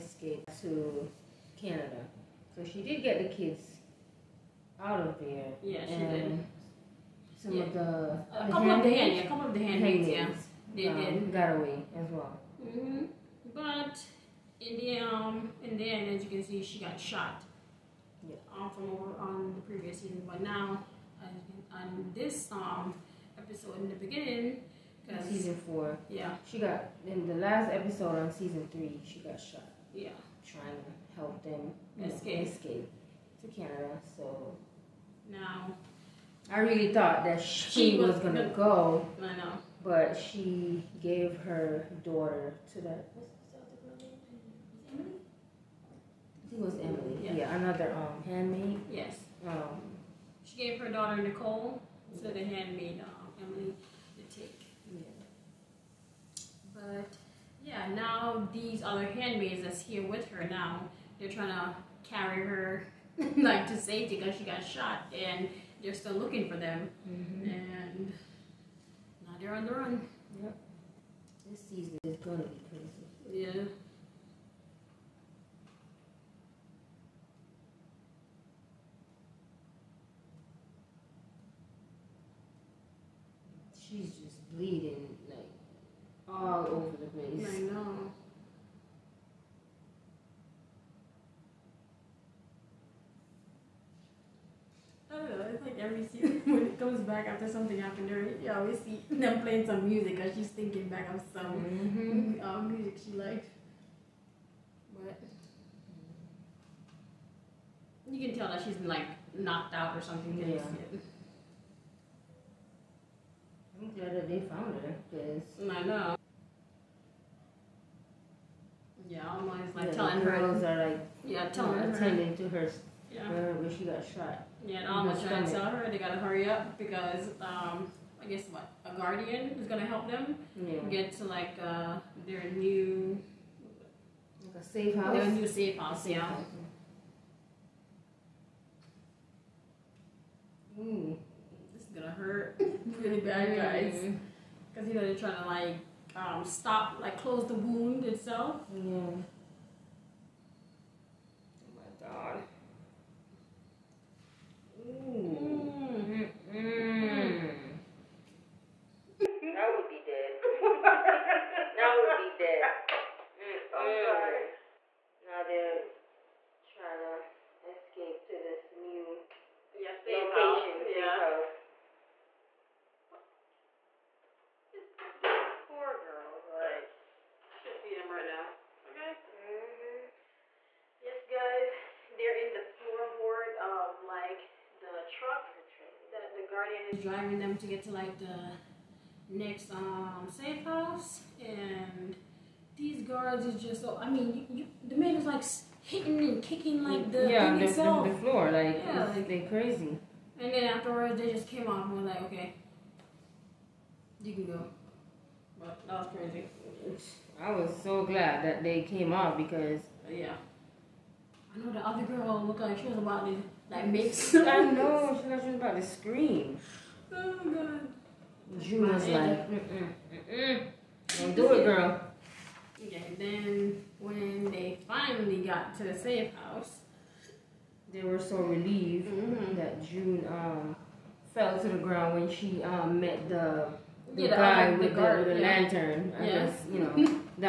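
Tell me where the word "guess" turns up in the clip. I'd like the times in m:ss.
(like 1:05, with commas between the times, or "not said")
2:08, 3:56.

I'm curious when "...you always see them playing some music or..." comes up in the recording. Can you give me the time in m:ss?
1:38.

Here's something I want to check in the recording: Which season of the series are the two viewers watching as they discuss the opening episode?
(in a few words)
Season 4.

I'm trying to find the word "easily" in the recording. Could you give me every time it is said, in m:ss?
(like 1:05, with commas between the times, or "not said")
not said.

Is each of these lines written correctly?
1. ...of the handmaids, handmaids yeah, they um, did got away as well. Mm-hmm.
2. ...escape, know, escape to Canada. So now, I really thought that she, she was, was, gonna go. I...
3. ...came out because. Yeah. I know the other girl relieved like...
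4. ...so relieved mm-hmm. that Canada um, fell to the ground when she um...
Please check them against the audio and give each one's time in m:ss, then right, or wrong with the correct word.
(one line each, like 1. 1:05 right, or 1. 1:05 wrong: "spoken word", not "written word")
1. 0:09 right
2. 0:32 right
3. 3:28 wrong: "looked", not "relieved"
4. 3:48 wrong: "June", not "Canada".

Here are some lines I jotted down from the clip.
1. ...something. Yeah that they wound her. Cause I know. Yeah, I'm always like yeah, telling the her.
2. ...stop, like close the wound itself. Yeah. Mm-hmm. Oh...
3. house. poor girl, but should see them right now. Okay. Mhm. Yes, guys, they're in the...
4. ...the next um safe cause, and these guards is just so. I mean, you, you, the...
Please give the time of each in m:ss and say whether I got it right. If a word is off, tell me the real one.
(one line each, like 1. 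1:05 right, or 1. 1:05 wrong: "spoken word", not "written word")
1. 1:50 wrong: "found", not "wound"
2. 2:26 right
3. 2:51 right
4. 3:08 wrong: "house", not "cause".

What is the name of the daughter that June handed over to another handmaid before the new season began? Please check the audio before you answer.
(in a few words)
Nicole.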